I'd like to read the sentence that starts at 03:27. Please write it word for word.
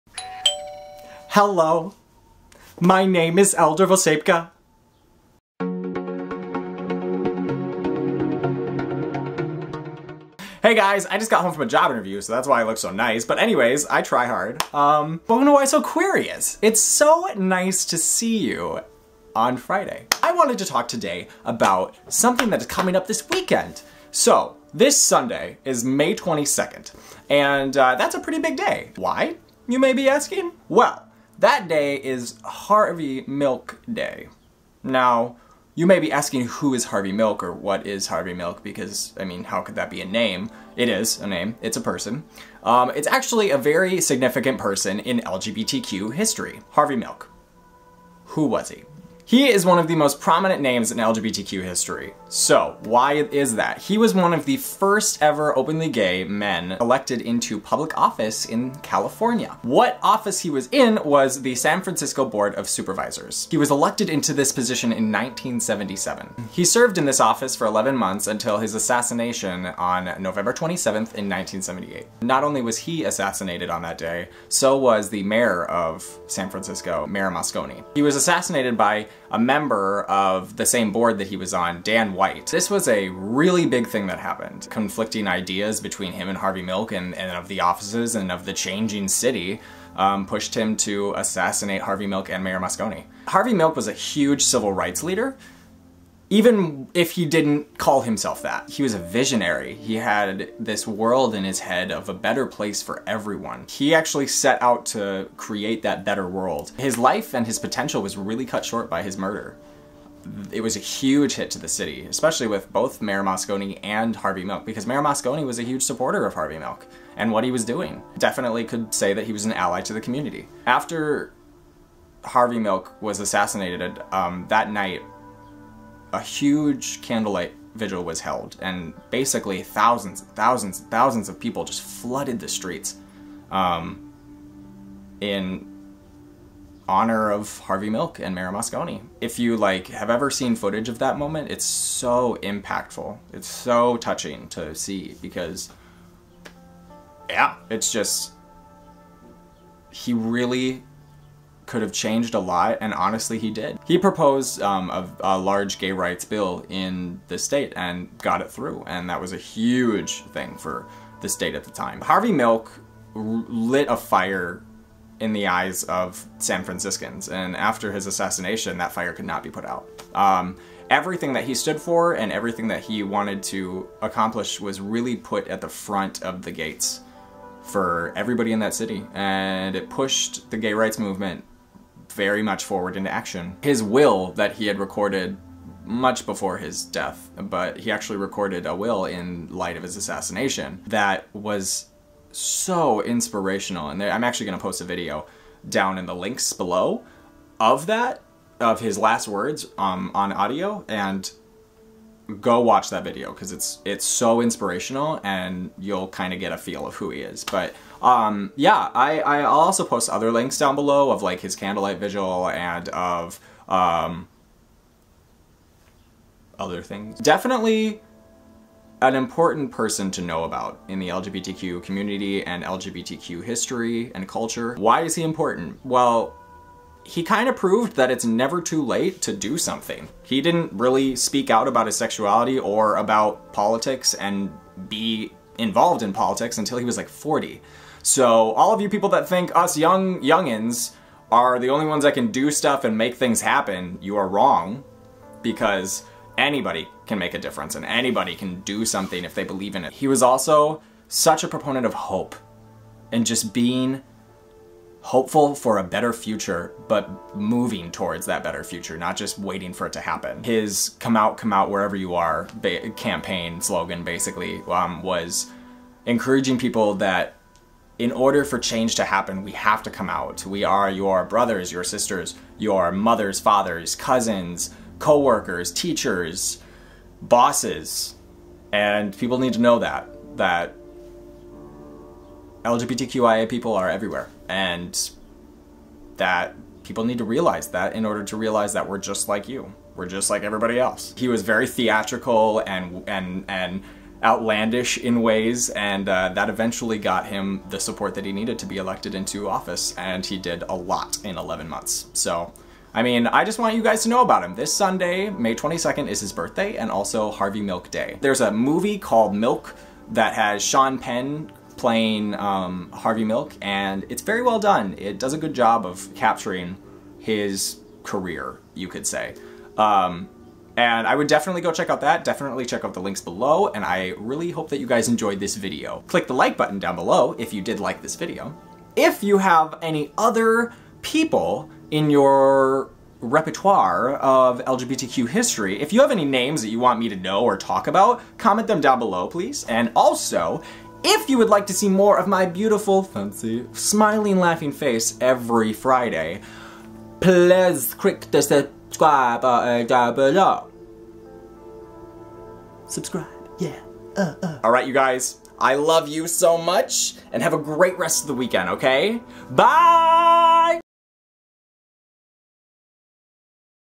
But um, yeah, I, I'll also post other links down below of like his candlelight vigil and of um, other things.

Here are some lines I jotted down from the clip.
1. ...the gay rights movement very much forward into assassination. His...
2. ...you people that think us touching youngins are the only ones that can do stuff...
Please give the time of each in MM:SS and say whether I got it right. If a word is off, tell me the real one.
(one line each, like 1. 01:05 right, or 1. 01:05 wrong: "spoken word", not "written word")
1. 03:00 wrong: "action", not "assassination"
2. 03:58 wrong: "young", not "touching".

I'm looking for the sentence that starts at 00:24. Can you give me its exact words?
So, this Sunday is May 22nd, and uh, that's a pretty big day.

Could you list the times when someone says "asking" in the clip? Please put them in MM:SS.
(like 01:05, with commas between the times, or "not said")
00:30, 00:36.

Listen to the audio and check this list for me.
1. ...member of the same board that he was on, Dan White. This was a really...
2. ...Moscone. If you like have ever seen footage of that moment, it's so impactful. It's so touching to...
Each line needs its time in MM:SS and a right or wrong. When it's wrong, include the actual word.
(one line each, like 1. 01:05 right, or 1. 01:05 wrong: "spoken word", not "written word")
1. 01:19 right
2. 02:18 right.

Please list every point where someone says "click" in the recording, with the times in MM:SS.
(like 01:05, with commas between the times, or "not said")
05:26, 05:47.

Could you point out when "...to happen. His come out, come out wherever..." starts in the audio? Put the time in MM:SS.
04:19.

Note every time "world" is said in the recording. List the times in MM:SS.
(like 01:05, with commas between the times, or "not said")
01:40, 01:46.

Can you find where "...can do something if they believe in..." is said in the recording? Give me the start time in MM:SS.
04:08.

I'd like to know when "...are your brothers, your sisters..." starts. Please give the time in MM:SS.
04:30.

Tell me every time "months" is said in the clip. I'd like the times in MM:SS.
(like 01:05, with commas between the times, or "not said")
01:07, 05:01.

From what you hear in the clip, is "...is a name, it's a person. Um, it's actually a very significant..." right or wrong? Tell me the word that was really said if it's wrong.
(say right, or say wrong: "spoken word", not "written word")
right.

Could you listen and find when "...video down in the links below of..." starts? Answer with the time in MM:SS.
03:14.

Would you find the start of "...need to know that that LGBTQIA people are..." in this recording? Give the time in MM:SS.
04:39.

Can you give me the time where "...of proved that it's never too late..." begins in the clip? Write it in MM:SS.
03:47.